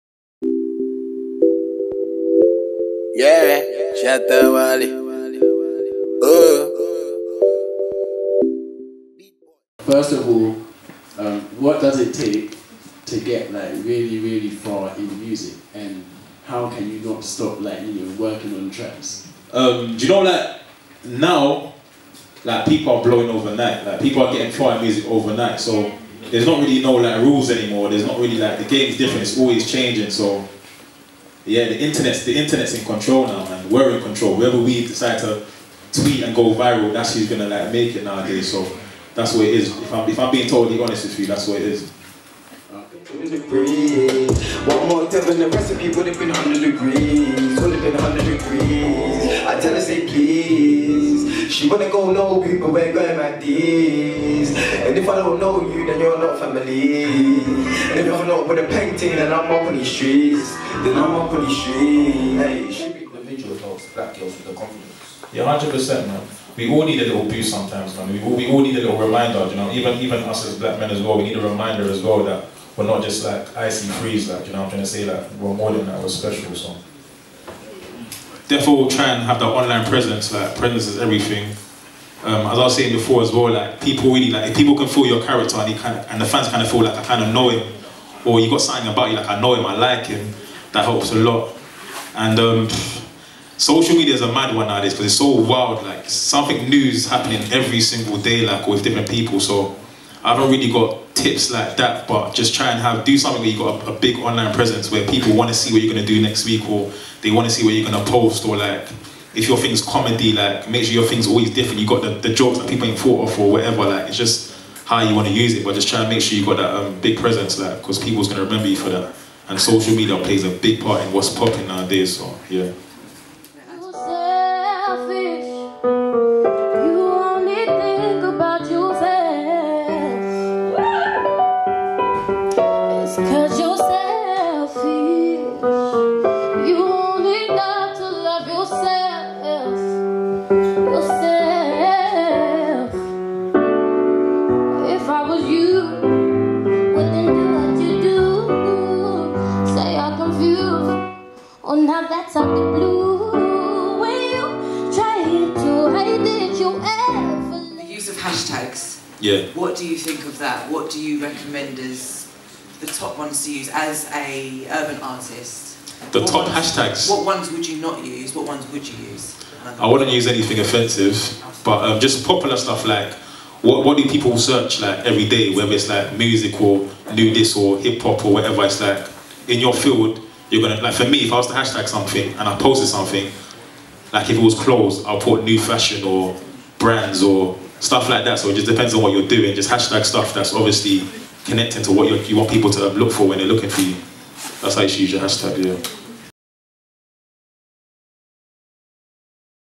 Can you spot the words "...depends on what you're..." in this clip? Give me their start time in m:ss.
3:08.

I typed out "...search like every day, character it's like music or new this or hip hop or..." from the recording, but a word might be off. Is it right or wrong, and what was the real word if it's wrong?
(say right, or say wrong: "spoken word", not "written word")
wrong: "whether", not "character".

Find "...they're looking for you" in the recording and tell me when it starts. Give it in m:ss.
3:13.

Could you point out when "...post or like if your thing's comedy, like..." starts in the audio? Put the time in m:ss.
1:48.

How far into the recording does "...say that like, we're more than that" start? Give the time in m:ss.
1:14.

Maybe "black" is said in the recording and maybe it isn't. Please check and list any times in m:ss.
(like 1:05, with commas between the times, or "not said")
1:03, 1:10.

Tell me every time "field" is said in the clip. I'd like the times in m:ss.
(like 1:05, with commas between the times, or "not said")
2:59.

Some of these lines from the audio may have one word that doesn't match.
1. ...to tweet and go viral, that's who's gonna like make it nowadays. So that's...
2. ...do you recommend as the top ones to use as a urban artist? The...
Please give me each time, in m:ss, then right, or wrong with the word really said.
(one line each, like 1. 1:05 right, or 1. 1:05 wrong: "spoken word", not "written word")
1. 0:35 right
2. 2:40 right.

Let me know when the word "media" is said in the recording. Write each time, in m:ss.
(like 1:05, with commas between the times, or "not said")
1:33, 1:59.